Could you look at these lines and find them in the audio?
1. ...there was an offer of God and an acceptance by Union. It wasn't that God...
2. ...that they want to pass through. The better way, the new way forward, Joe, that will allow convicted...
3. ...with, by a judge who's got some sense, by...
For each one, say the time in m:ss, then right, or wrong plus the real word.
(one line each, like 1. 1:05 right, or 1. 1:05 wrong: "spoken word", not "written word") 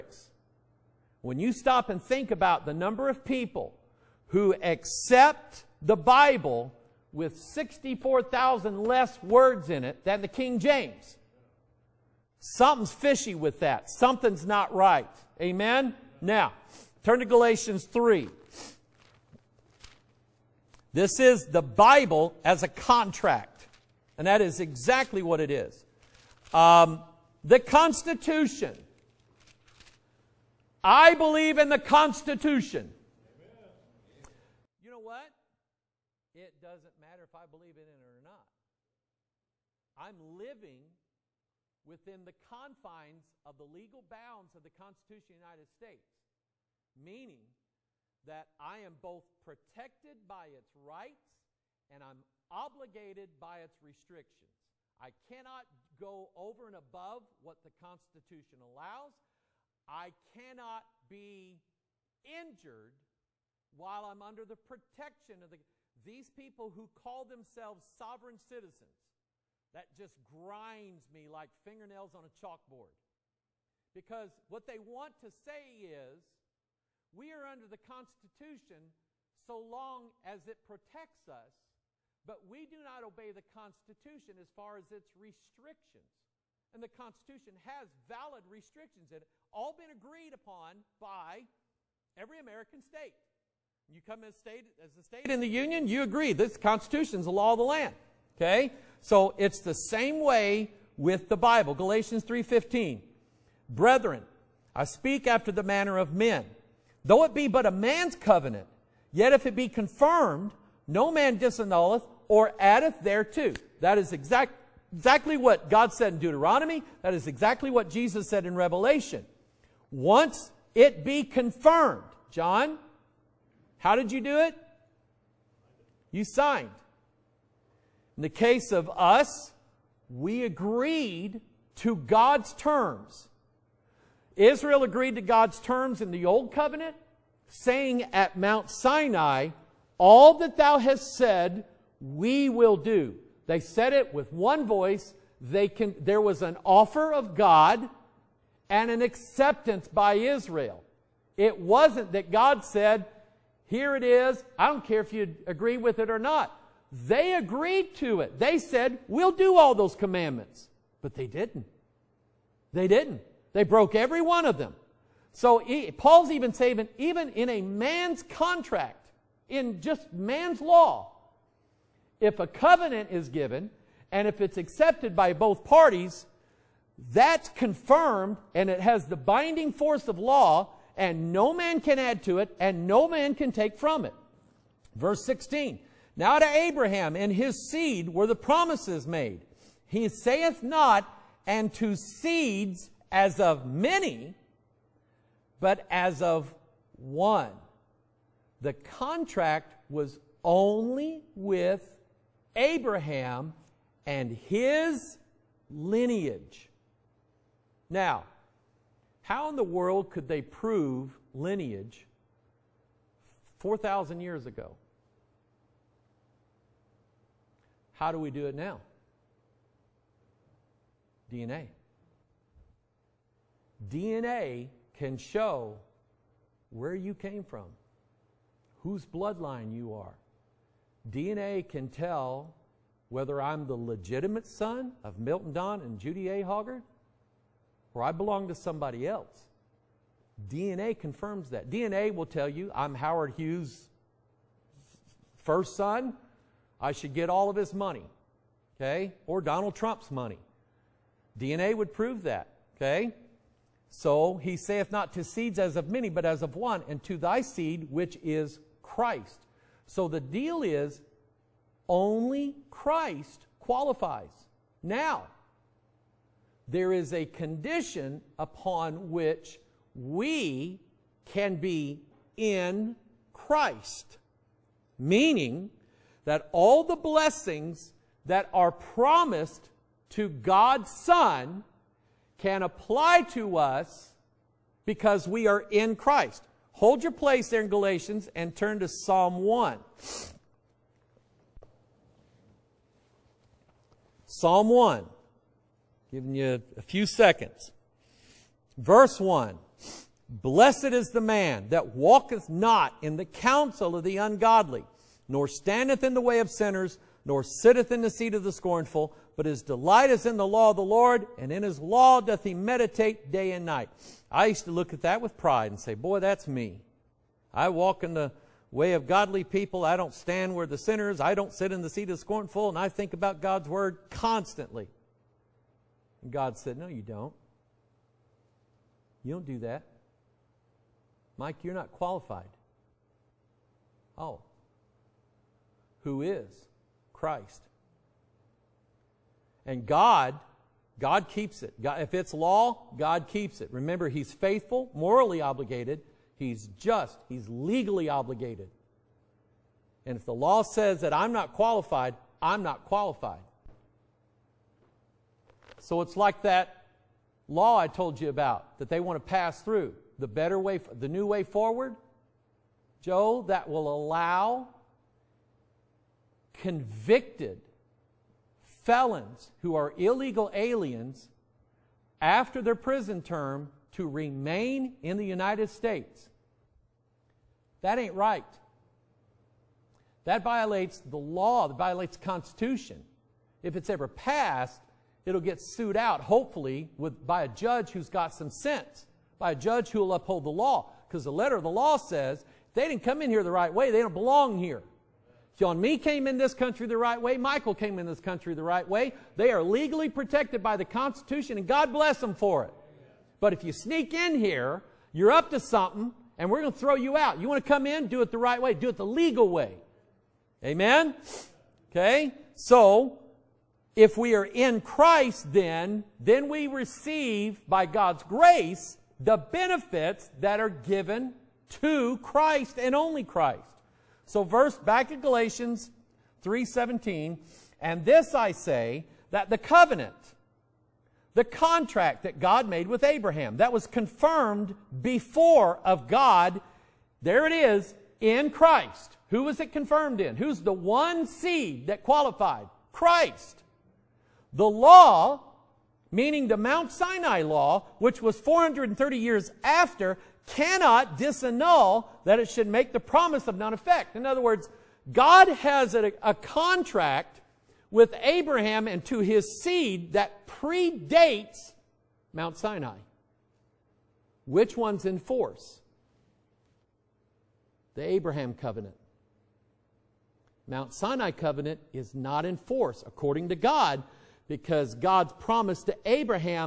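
1. 2:26 wrong: "Israel", not "Union"
2. 5:58 right
3. 6:26 right.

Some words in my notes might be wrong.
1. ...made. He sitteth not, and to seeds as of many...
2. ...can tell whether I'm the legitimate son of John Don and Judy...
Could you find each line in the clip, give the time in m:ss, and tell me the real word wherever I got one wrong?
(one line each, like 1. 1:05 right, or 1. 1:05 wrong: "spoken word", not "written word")
1. 3:09 wrong: "saith", not "sitteth"
2. 3:51 wrong: "Milton", not "John".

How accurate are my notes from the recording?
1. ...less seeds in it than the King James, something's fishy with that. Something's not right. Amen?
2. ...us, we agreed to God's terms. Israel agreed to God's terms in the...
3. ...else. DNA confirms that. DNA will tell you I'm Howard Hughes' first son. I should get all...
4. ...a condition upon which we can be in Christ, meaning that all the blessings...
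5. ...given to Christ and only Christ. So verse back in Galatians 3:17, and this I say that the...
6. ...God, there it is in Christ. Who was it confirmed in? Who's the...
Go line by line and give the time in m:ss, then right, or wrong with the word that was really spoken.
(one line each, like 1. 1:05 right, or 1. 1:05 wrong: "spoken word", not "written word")
1. 0:08 wrong: "words", not "seeds"
2. 2:08 right
3. 3:59 right
4. 4:27 right
5. 7:00 right
6. 7:16 right.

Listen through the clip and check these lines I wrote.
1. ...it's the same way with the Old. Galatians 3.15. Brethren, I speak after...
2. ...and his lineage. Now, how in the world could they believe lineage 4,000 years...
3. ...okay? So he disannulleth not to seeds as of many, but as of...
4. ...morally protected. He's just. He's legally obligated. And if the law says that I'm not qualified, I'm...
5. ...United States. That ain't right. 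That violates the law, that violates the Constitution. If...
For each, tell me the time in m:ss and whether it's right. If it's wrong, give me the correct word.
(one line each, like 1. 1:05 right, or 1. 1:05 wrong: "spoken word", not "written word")
1. 1:39 wrong: "Bible", not "Old"
2. 3:24 wrong: "prove", not "believe"
3. 4:12 wrong: "saith", not "disannulleth"
4. 5:44 wrong: "obligated", not "protected"
5. 6:15 right.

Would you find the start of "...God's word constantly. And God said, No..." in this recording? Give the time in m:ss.
5:23.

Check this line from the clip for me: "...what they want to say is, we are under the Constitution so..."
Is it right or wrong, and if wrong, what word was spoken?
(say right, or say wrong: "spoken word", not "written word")
right.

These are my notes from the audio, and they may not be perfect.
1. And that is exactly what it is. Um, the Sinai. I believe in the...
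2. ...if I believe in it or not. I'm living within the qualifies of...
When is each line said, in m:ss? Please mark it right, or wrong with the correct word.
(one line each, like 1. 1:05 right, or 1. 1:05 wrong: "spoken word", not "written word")
1. 0:24 wrong: "Constitution", not "Sinai"
2. 0:37 wrong: "confines", not "qualifies".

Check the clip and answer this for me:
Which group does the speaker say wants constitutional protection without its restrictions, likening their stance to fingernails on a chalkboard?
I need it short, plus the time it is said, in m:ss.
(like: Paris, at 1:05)
sovereign citizens, at 1:07.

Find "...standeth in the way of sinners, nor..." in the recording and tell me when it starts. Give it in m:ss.
5:05.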